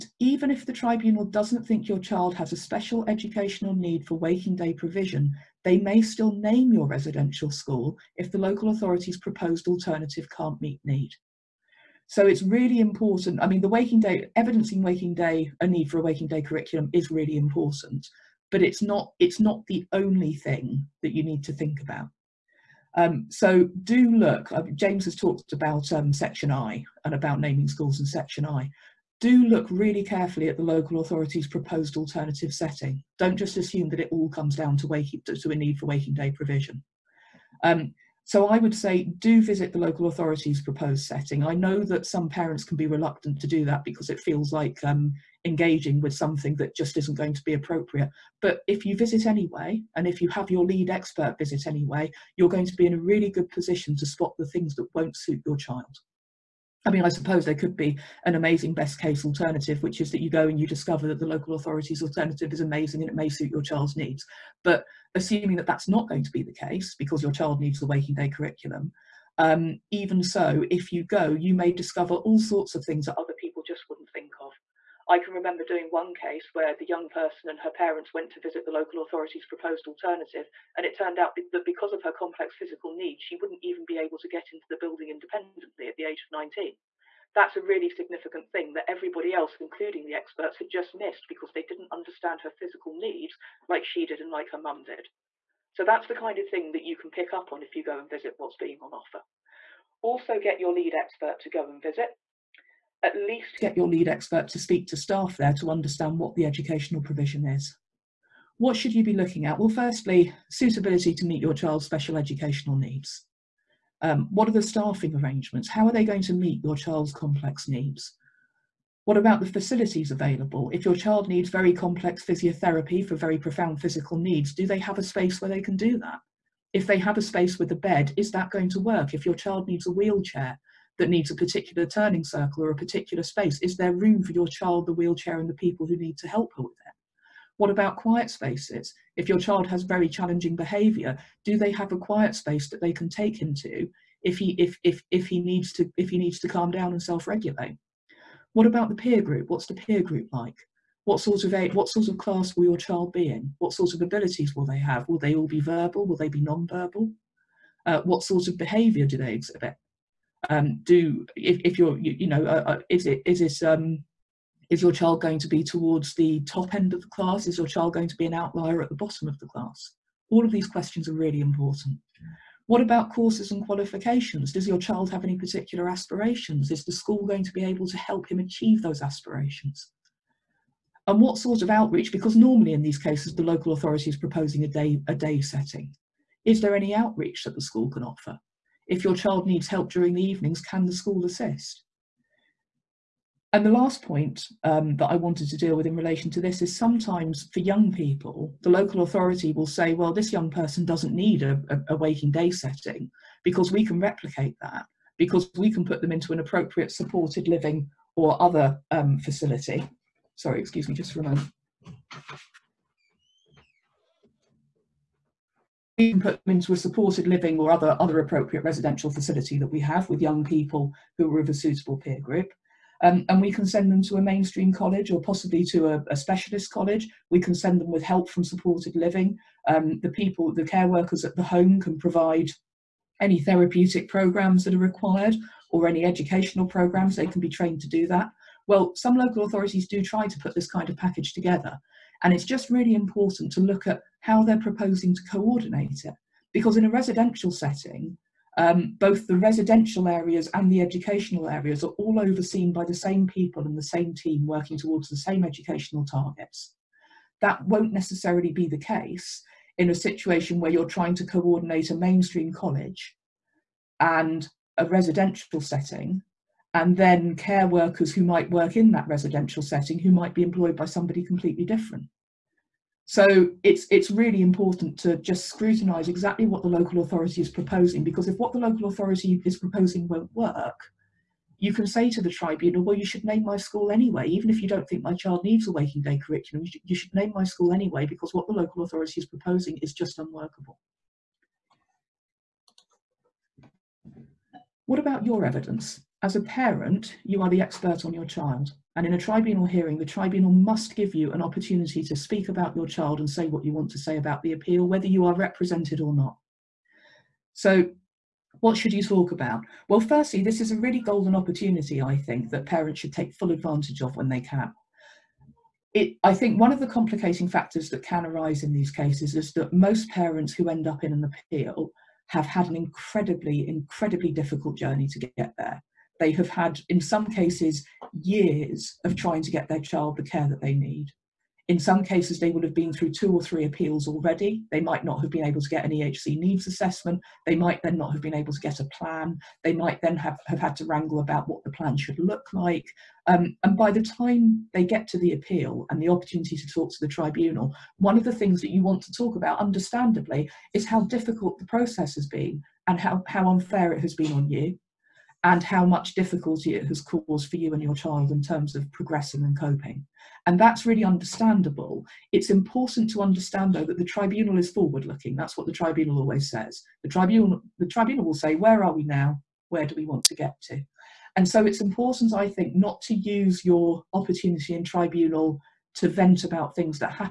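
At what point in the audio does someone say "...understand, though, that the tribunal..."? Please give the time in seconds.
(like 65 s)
363 s.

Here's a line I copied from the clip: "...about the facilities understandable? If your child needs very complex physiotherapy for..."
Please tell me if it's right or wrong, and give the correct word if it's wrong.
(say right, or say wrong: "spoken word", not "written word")
wrong: "available", not "understandable".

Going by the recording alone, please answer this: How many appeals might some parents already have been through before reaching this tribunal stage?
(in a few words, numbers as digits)
2 or 3.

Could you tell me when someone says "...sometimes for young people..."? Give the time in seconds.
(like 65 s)
196 s.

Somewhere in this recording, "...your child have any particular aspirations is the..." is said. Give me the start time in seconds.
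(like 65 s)
174 s.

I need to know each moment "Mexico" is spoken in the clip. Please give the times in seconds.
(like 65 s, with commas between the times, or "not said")
not said.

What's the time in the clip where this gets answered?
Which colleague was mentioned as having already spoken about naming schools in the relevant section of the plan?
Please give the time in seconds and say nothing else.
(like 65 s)
24 s.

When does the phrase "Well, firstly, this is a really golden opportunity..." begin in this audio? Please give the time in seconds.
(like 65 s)
309 s.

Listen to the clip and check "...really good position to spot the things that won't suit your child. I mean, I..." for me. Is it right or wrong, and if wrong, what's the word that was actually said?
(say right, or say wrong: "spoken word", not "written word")
right.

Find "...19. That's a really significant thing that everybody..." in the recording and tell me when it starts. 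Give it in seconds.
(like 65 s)
86 s.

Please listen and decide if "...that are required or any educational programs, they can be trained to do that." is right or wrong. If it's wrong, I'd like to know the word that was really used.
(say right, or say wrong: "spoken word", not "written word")
right.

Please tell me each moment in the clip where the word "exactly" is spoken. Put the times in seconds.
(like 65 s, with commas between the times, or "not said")
276 s.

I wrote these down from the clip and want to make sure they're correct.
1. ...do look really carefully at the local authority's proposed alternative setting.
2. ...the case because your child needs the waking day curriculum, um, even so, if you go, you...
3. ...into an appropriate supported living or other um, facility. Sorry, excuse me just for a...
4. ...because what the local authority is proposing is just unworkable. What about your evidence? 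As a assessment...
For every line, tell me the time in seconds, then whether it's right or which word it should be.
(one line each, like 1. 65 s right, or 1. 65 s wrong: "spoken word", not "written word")
1. 29 s right
2. 66 s right
3. 206 s right
4. 288 s wrong: "parent", not "assessment".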